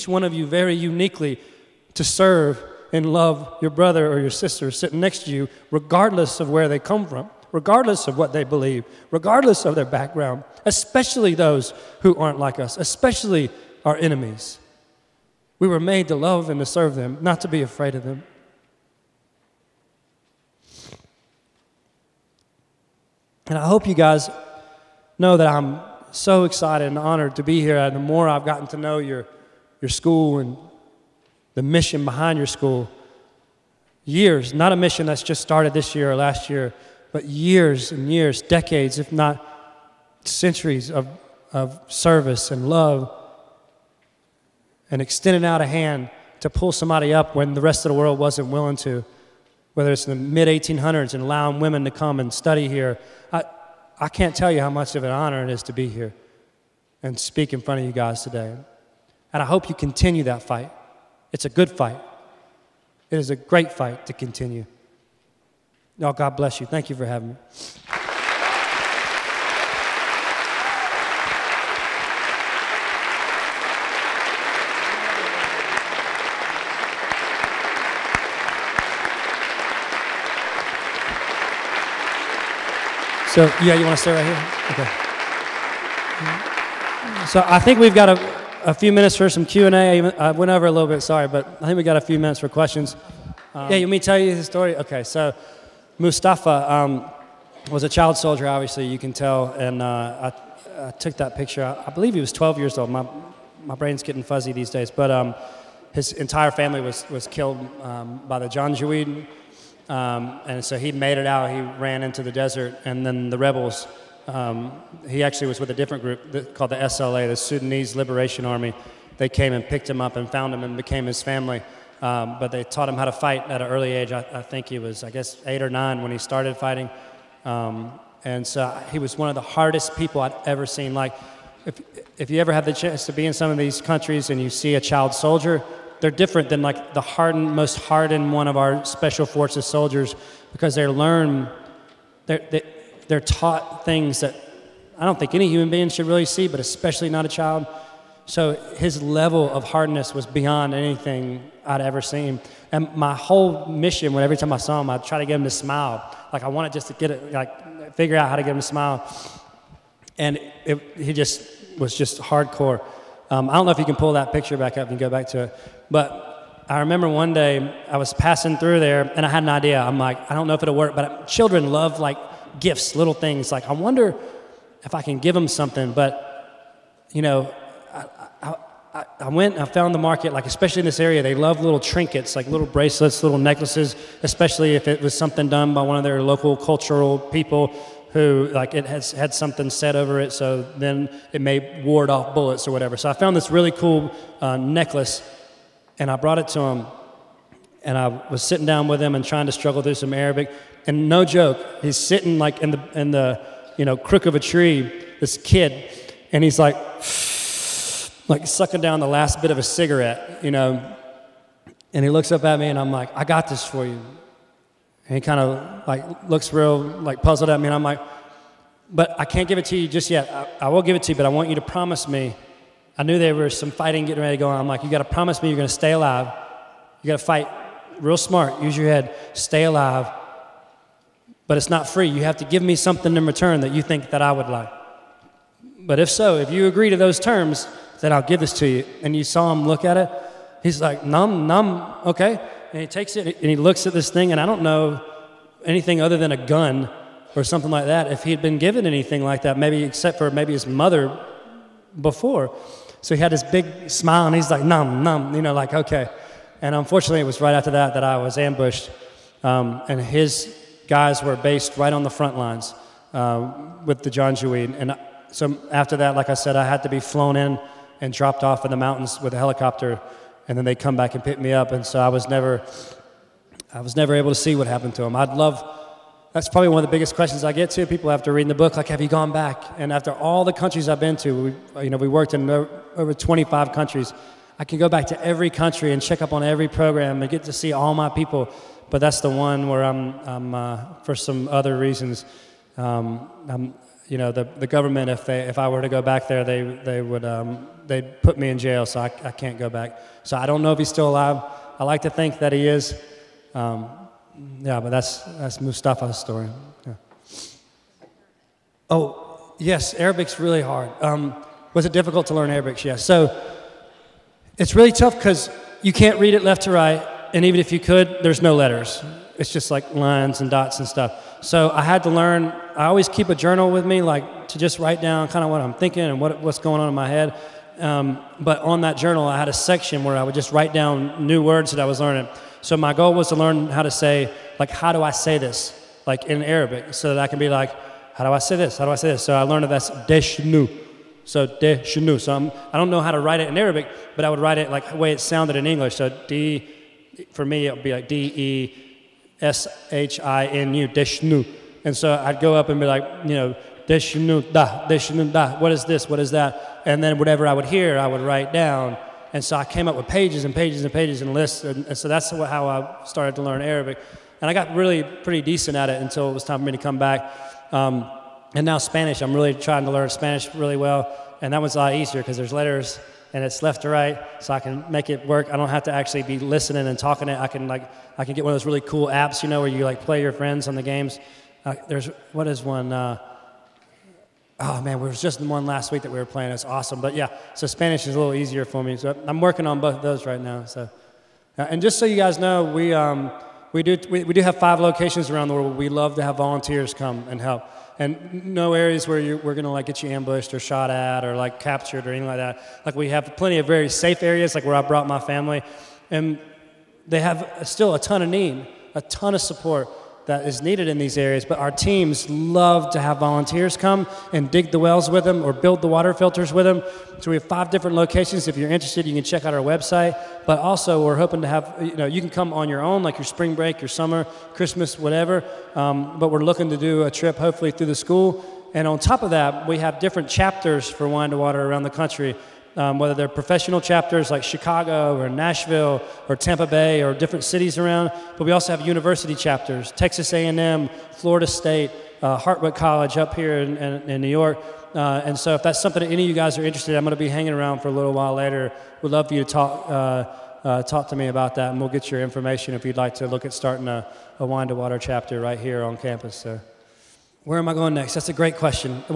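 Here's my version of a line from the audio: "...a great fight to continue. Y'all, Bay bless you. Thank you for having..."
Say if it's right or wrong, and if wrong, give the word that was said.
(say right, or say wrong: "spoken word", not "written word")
wrong: "God", not "Bay".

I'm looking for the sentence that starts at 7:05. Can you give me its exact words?
Um, but we're looking to do a trip, hopefully, through the school.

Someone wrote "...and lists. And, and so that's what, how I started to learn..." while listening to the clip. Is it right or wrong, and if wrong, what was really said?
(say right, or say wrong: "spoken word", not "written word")
right.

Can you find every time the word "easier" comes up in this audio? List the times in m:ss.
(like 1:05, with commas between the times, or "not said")
6:11, 6:28.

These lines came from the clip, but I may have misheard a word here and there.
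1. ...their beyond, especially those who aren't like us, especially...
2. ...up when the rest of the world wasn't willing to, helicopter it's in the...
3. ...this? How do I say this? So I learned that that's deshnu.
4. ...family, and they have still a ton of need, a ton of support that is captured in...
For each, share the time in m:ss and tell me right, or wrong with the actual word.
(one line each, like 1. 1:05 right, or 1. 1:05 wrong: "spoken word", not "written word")
1. 0:09 wrong: "background", not "beyond"
2. 0:47 wrong: "whether", not "helicopter"
3. 5:38 right
4. 6:45 wrong: "needed", not "captured".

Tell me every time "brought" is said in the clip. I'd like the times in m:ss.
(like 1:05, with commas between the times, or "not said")
3:16, 6:44.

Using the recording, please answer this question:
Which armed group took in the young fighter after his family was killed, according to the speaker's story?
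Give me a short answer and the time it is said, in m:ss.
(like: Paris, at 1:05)
Sudanese Liberation Army, at 1:57.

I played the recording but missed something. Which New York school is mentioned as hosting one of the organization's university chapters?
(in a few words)
Hartwick College.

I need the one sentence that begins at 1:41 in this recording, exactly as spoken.
I, I, believe he was 12 years old.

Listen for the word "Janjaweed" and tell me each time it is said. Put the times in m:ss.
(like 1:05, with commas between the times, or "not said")
1:48, 4:24.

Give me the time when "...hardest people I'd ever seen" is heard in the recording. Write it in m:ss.
2:09.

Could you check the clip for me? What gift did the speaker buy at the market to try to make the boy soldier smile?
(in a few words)
necklace.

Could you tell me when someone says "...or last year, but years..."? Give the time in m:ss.
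0:36.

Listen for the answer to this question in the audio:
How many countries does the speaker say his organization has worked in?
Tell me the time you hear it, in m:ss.
4:42.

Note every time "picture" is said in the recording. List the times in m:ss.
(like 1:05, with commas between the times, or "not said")
1:41, 2:44.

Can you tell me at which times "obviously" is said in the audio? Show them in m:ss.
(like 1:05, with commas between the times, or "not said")
1:38.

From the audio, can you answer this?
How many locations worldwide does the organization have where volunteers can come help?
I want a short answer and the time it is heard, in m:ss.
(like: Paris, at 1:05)
5, at 6:34.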